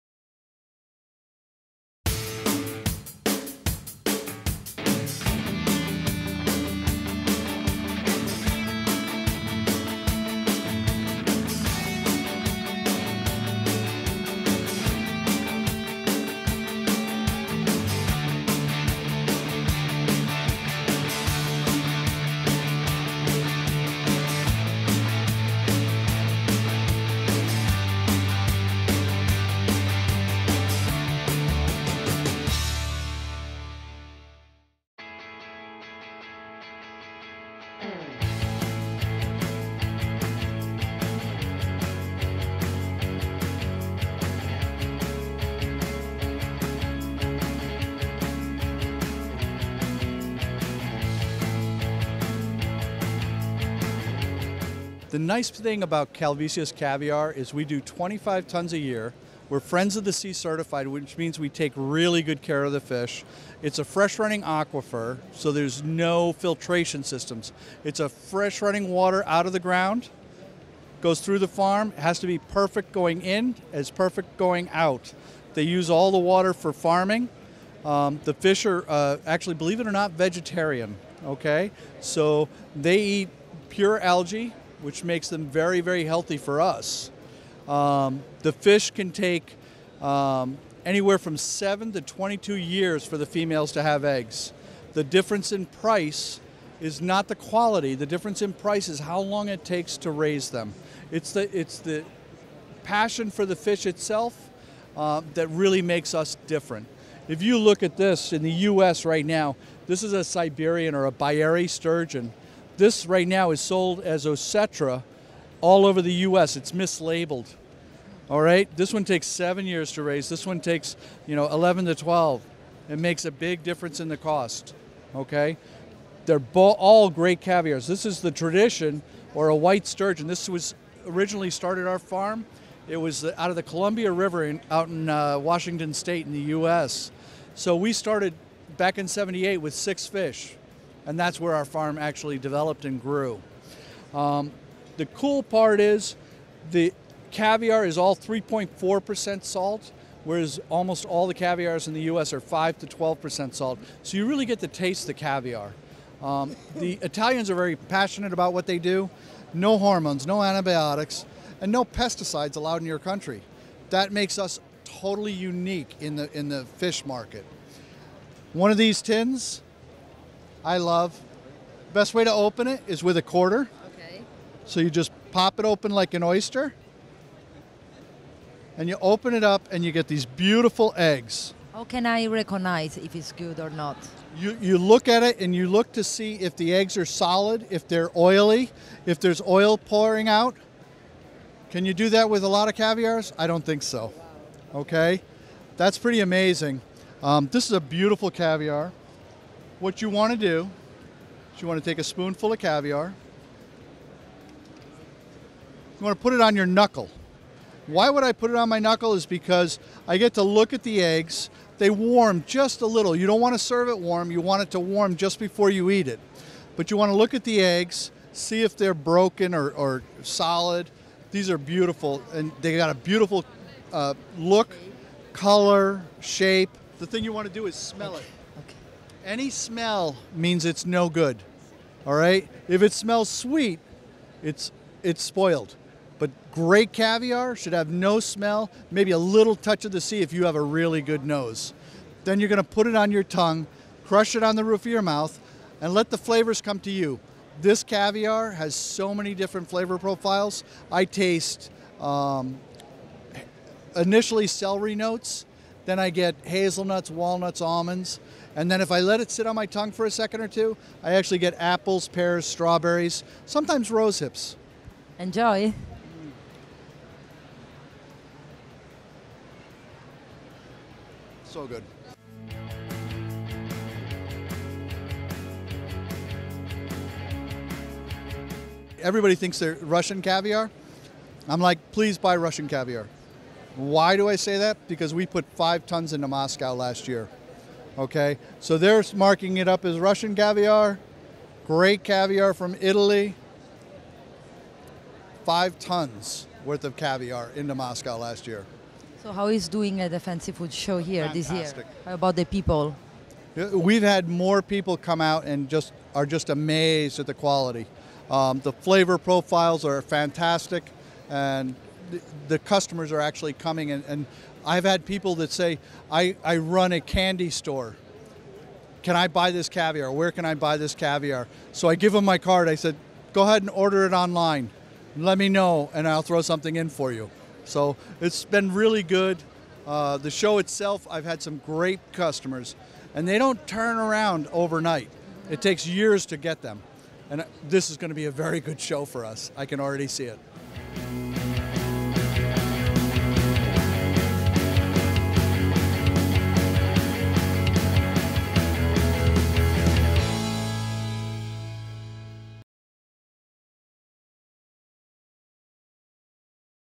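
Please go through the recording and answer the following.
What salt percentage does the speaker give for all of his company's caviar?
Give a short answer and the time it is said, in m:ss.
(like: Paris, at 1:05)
3.4%, at 2:28.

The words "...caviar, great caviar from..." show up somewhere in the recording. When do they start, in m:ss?
4:50.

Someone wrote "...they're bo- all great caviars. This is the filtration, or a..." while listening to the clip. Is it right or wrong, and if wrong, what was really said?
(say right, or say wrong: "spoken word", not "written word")
wrong: "tradition", not "filtration".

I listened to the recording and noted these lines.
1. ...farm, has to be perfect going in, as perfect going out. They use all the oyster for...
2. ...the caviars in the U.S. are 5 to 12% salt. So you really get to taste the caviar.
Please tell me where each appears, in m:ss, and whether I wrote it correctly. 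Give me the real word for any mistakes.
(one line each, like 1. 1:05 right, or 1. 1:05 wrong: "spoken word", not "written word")
1. 1:11 wrong: "water", not "oyster"
2. 2:31 right.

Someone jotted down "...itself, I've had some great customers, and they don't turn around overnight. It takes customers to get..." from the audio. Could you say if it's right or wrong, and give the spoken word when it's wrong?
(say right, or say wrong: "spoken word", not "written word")
wrong: "years", not "customers".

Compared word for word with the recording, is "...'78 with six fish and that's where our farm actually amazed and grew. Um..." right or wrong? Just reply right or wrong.
wrong.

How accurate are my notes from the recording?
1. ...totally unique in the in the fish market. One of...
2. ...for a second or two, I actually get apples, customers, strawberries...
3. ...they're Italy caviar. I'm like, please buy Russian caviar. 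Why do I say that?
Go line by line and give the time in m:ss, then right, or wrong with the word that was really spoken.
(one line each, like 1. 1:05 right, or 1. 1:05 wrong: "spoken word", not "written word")
1. 2:44 right
2. 4:19 wrong: "pears", not "customers"
3. 4:39 wrong: "Russian", not "Italy".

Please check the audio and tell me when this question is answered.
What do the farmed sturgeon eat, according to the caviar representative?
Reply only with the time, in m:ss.
1:23.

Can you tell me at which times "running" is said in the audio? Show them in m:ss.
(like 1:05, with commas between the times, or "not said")
1:04, 1:08.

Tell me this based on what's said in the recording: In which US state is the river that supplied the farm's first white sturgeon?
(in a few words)
Washington State.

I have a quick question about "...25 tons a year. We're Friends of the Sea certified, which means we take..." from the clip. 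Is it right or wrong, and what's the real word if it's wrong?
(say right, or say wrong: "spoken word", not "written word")
right.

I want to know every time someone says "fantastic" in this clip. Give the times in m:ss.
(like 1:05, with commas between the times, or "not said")
5:01, 5:10.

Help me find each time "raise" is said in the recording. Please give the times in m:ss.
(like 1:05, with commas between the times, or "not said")
1:40, 2:00.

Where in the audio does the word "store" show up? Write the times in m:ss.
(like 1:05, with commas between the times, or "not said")
5:17.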